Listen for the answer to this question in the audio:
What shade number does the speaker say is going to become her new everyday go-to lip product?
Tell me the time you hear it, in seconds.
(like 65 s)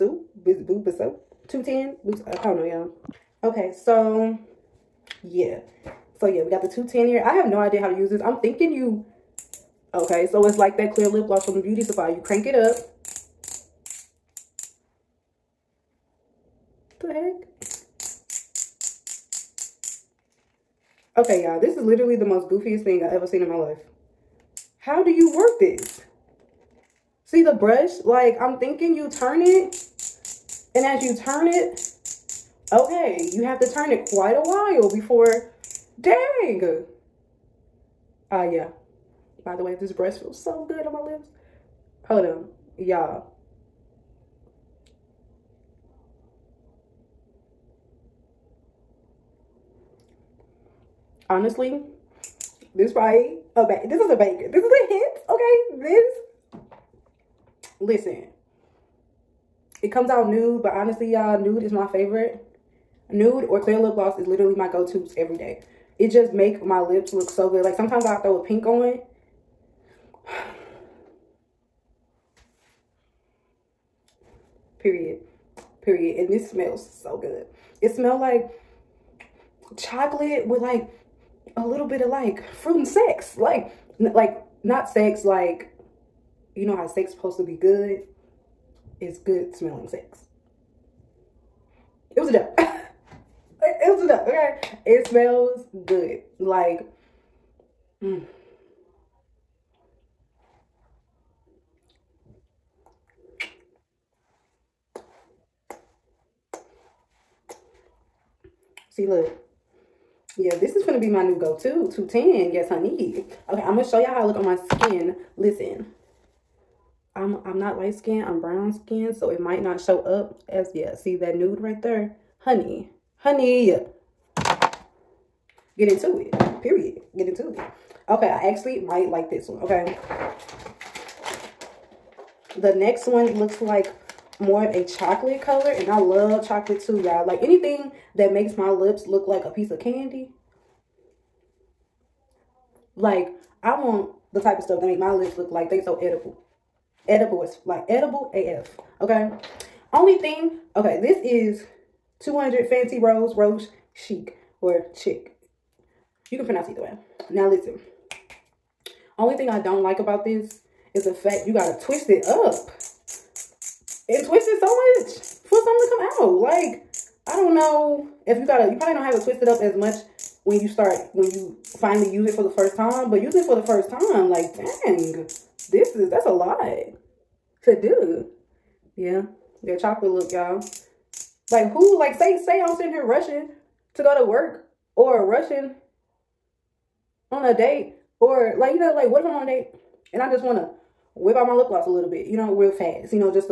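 111 s.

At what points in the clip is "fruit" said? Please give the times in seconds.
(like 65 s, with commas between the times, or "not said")
82 s.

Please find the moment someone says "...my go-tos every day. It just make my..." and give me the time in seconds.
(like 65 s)
64 s.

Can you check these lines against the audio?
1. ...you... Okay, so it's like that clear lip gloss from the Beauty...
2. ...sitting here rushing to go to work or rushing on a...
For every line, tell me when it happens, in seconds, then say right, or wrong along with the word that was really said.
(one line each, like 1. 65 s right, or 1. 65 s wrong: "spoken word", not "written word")
1. 8 s right
2. 182 s right.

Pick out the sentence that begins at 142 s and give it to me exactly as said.
Like, I want the type of stuff that make my lips look like they so edible.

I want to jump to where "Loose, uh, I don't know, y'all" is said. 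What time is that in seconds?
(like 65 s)
2 s.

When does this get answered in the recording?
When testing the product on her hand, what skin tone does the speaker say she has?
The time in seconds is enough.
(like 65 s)
118 s.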